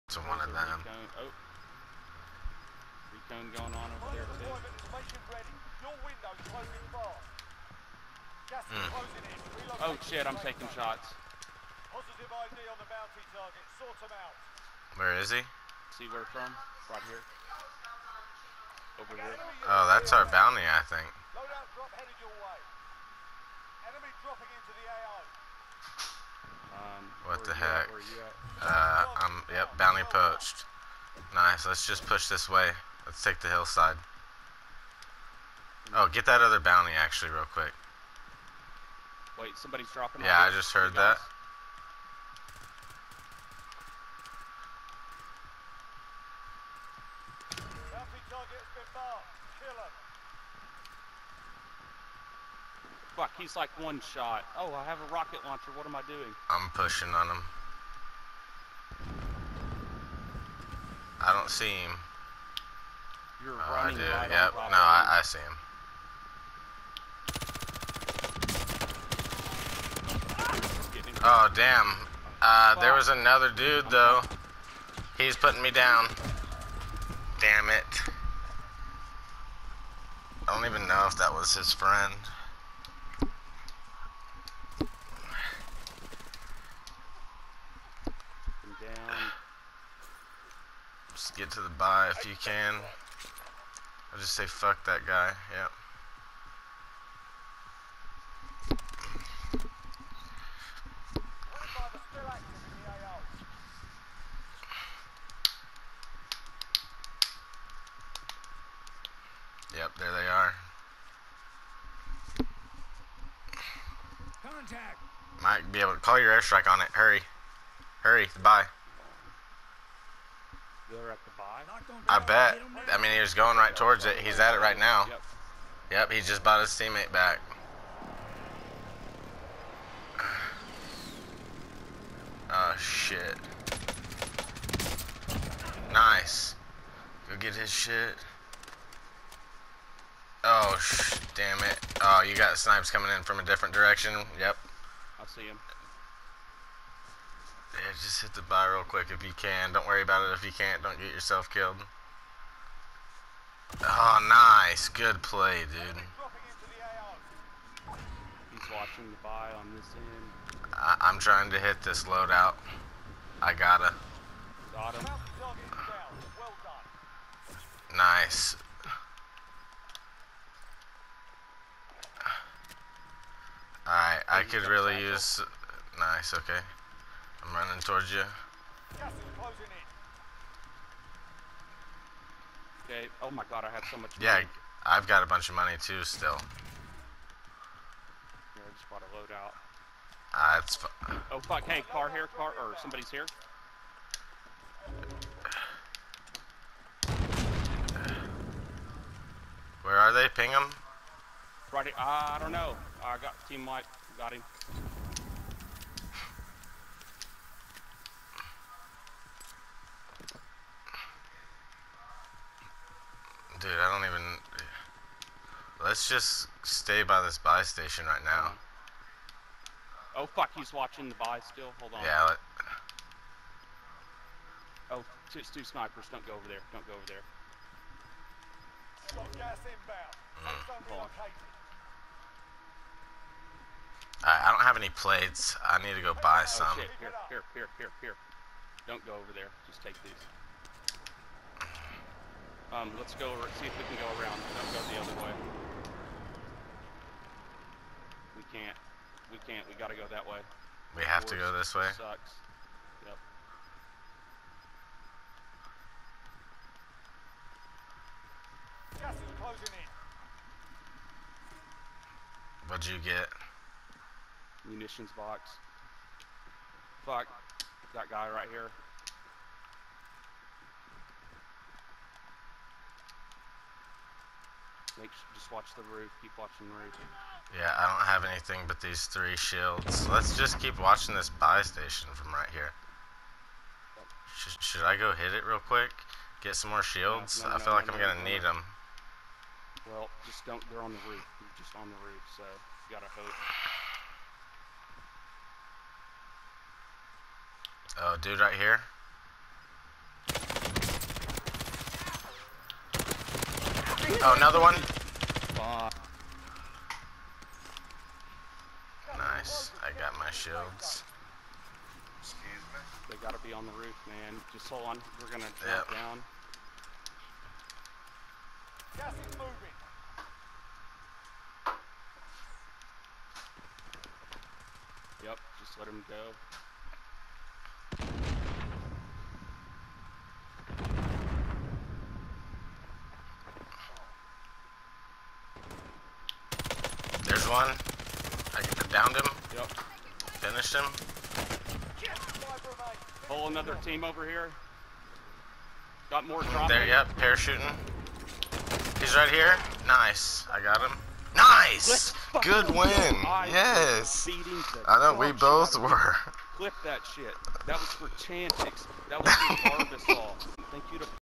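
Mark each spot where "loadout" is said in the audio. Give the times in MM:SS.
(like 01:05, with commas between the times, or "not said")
00:21, 02:42, 03:09.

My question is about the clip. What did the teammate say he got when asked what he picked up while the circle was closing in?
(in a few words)
Munitions box.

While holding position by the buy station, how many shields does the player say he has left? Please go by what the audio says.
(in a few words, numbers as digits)
3.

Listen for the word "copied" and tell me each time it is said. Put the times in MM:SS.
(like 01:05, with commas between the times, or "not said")
not said.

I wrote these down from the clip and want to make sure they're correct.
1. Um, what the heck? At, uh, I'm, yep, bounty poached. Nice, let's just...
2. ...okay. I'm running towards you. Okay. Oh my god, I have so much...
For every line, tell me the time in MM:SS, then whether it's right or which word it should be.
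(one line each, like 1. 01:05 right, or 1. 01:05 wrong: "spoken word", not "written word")
1. 00:26 right
2. 02:56 right.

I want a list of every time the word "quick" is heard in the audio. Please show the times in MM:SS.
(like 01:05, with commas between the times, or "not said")
00:37, 02:28, 04:45.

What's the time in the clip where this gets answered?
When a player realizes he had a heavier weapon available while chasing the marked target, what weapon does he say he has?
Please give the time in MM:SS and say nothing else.
00:55.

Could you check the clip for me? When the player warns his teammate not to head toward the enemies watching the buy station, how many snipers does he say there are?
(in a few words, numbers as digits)
2.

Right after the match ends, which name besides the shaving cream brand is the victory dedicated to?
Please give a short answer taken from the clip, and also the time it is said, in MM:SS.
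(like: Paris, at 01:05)
Chantix, at 05:58.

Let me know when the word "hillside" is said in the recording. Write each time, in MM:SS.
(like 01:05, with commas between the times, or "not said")
00:33.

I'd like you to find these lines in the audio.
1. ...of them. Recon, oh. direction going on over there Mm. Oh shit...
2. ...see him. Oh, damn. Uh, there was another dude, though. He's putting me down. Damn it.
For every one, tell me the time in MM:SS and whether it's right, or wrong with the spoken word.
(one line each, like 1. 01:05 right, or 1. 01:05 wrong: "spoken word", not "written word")
1. 00:00 wrong: "recon", not "direction"
2. 01:05 right.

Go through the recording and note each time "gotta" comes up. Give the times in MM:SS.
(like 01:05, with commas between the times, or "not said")
02:43, 04:09, 04:52, 05:13.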